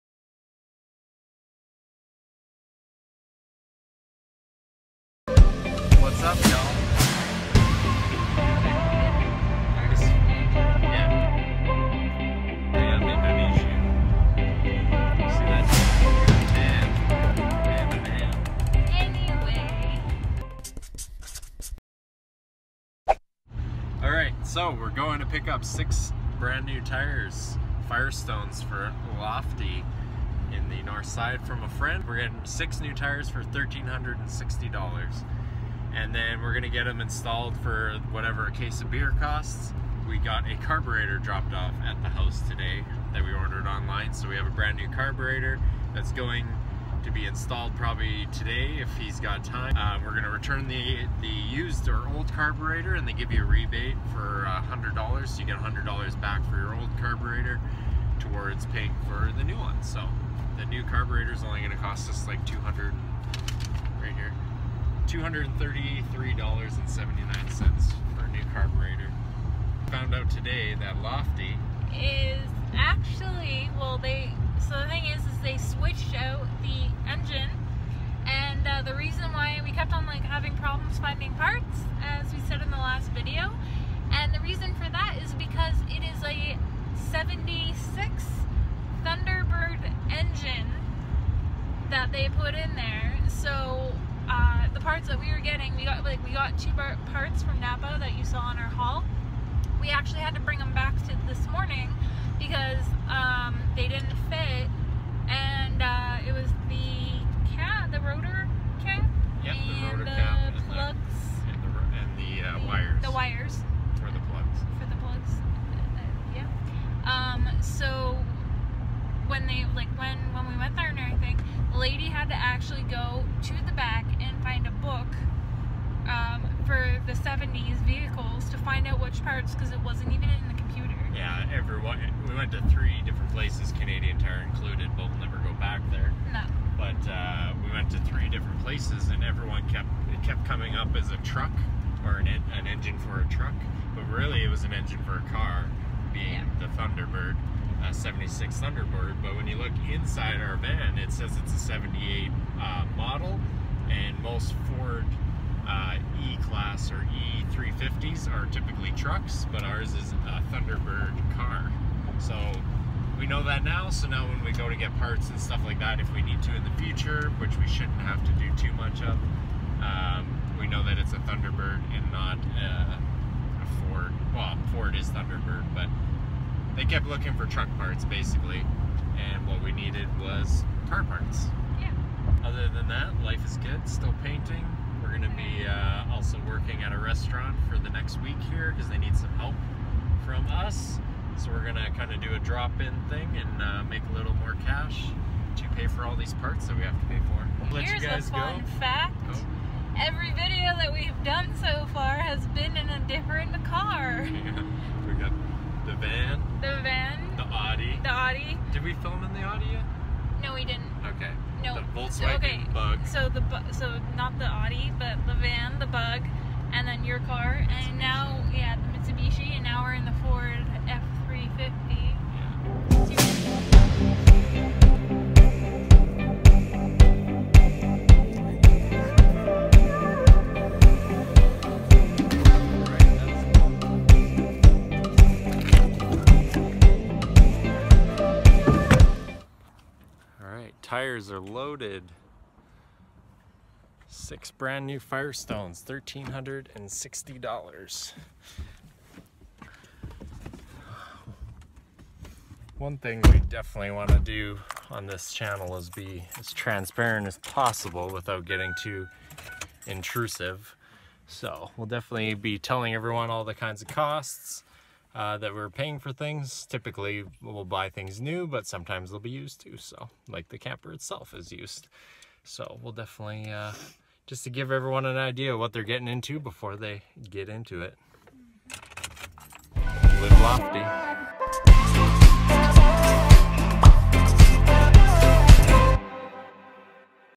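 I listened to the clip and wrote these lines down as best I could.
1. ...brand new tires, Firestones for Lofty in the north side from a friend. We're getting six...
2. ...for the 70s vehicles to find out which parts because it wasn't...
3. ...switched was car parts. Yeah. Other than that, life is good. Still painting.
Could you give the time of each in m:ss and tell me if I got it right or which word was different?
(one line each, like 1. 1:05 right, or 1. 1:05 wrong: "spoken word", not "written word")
1. 0:26 right
2. 2:06 right
3. 2:59 wrong: "needed", not "switched".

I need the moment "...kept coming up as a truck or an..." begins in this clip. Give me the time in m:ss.
2:20.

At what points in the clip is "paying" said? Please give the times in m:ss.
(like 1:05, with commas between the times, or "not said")
0:58, 4:25.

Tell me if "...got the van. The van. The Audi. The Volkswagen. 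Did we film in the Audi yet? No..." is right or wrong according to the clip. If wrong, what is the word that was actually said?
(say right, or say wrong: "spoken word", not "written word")
wrong: "Audi", not "Volkswagen".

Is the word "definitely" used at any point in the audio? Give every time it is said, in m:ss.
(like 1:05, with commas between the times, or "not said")
4:13, 4:21, 4:32.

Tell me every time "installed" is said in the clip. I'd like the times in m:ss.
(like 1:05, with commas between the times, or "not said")
0:37, 0:47.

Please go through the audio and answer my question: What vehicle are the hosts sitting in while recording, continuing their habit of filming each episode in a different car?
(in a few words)
Ford F350.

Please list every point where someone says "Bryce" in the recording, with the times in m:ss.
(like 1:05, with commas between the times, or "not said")
not said.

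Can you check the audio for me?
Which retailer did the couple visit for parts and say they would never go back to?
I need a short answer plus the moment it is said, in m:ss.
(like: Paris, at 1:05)
Canadian Tire, at 2:13.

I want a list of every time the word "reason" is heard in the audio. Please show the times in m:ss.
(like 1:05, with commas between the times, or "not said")
1:18, 1:24.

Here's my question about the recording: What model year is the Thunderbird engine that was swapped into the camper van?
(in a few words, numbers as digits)
1976.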